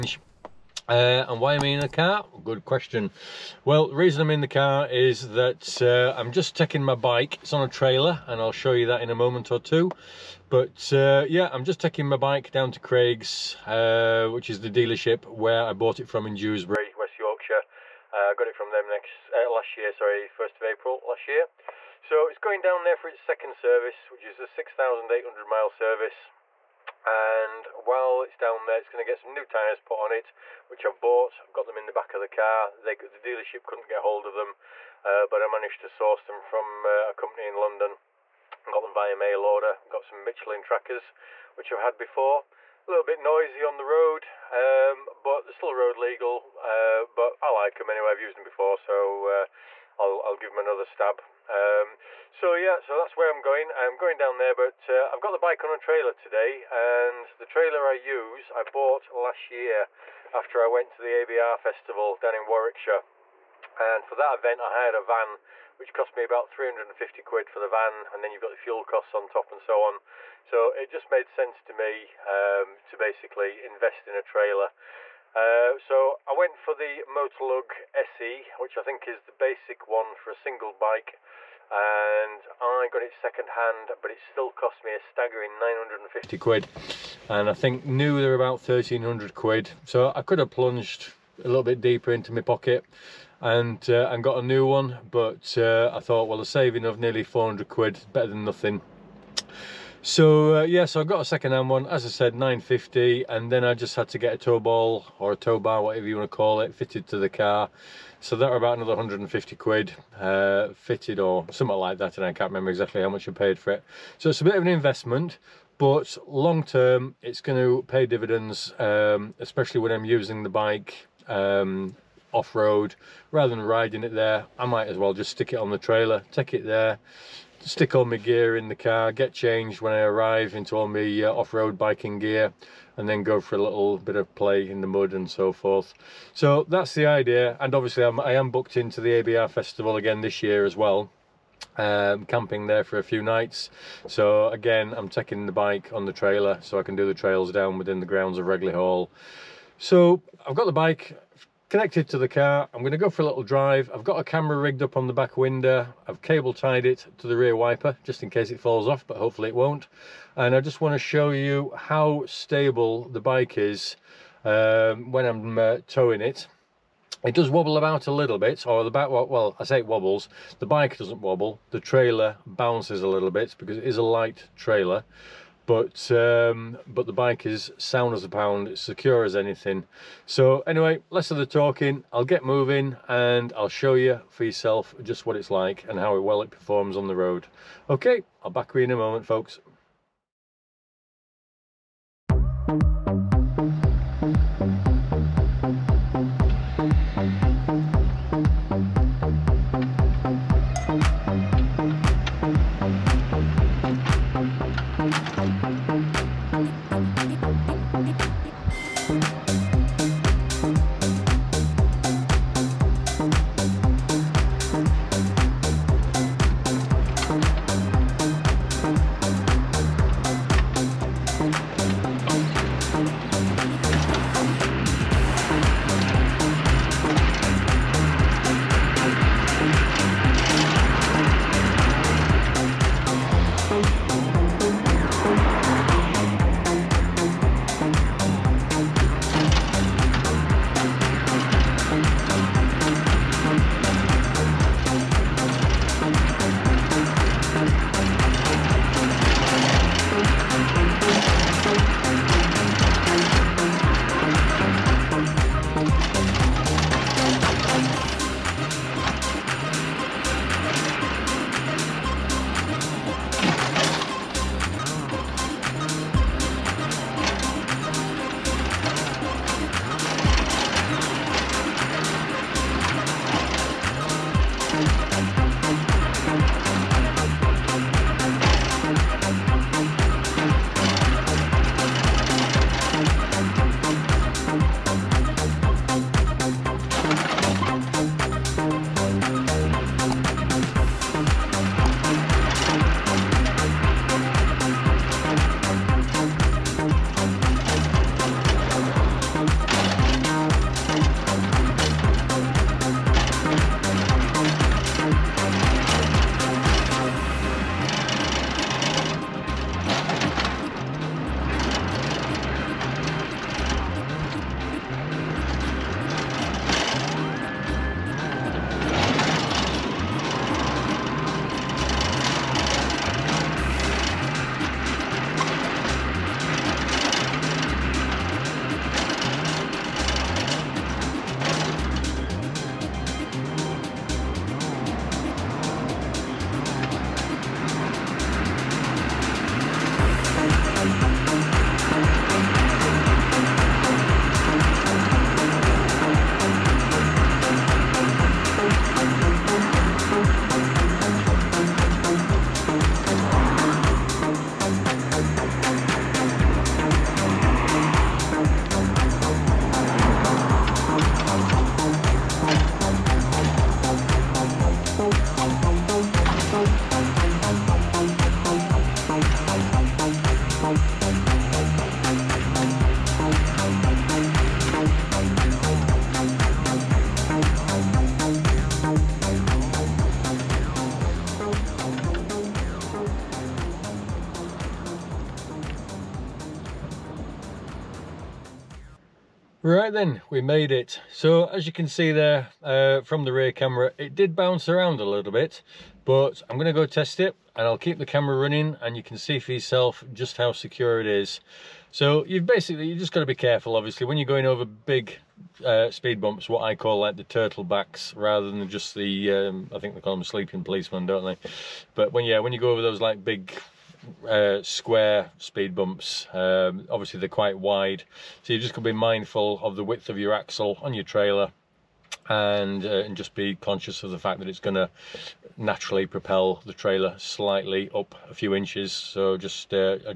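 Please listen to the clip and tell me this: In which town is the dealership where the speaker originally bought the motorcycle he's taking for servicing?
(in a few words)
Dewsbury.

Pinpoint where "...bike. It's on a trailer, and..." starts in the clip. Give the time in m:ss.
0:06.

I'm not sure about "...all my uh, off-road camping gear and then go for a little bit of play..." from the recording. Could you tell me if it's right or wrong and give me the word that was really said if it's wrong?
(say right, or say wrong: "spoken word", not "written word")
wrong: "biking", not "camping".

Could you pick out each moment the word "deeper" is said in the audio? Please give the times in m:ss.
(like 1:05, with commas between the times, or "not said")
1:31.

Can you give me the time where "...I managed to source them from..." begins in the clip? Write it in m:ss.
0:35.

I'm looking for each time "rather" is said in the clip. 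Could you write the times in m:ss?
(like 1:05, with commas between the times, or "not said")
2:03, 6:48.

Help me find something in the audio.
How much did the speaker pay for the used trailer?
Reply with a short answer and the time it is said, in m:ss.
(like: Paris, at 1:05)
£950, at 1:25.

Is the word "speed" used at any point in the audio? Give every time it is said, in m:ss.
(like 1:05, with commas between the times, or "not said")
6:45, 6:55.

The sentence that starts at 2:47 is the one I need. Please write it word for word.
It does wobble about a little bit, or the back, well, I say it wobbles.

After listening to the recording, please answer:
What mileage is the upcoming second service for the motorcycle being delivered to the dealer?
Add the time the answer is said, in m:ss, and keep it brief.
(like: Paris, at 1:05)
6,800 miles, at 0:24.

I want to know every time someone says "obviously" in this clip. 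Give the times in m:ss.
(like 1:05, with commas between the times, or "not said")
2:17, 6:43, 6:56.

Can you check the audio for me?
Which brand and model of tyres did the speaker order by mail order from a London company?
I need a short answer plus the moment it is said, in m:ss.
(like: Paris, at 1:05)
Michelin trackers, at 0:40.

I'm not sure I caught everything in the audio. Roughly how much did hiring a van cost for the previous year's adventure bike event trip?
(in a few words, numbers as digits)
£350.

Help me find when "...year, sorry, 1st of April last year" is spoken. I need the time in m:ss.
0:19.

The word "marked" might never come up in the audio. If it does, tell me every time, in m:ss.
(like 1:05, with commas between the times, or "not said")
not said.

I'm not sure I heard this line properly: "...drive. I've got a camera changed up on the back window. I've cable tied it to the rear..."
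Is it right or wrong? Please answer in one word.
wrong.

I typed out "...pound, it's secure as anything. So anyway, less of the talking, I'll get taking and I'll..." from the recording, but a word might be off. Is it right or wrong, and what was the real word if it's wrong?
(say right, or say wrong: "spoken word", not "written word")
wrong: "moving", not "taking".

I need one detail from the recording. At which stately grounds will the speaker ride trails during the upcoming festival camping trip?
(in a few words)
Ragley Hall.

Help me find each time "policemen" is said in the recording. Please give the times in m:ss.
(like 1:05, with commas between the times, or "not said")
6:50.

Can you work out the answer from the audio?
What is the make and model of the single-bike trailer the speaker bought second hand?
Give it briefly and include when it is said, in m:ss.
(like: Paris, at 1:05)
Motolug SE, at 1:17.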